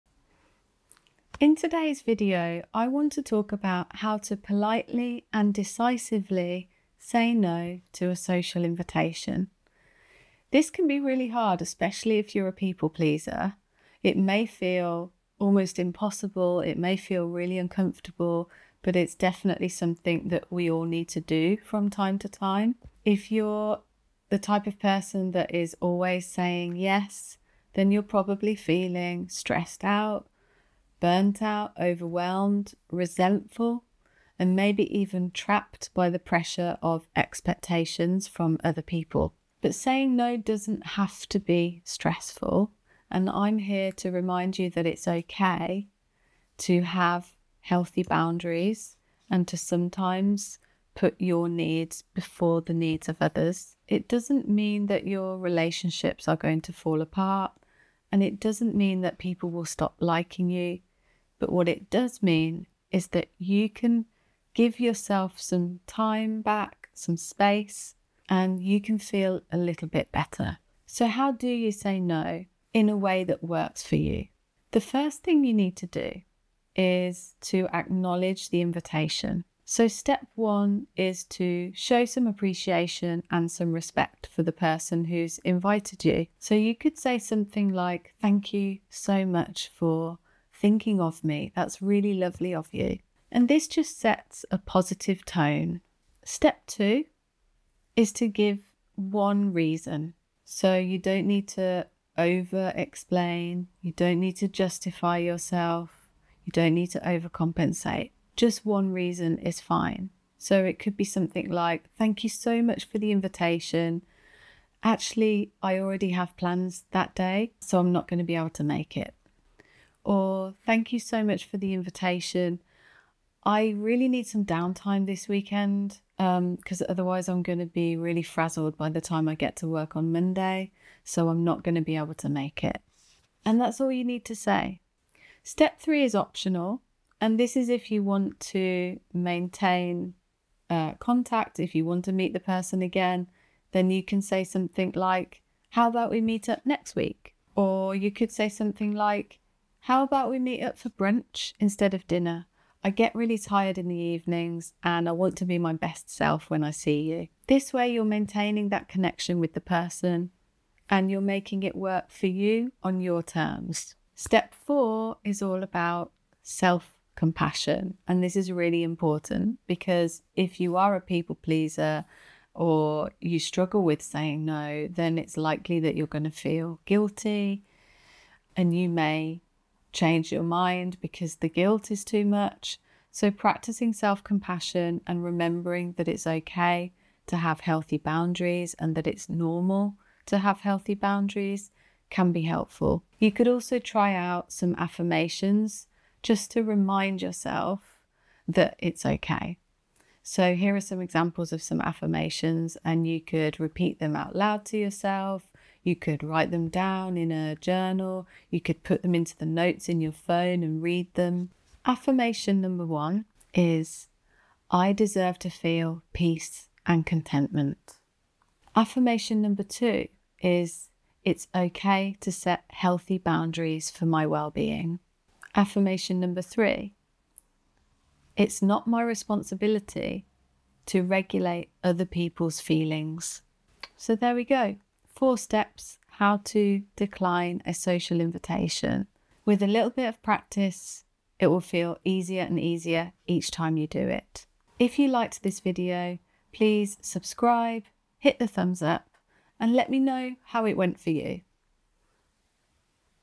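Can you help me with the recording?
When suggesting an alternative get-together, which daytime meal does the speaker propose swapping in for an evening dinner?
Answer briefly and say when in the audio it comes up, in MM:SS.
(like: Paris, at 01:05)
brunch, at 02:30.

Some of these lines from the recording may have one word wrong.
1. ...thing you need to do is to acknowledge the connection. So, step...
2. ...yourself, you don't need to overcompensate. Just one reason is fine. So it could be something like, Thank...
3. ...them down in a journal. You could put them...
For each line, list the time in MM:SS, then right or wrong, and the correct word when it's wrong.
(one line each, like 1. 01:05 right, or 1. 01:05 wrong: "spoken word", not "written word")
1. 01:15 wrong: "invitation", not "connection"
2. 01:45 right
3. 03:26 right.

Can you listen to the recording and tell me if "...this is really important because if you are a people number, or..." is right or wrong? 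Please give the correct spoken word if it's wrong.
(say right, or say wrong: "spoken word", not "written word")
wrong: "pleaser", not "number".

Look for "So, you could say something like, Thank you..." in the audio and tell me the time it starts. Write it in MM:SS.
01:26.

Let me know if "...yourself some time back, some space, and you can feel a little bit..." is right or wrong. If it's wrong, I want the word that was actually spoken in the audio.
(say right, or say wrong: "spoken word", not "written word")
right.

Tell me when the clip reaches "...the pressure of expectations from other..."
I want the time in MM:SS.
00:36.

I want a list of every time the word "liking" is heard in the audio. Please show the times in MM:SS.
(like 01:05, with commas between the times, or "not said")
00:59.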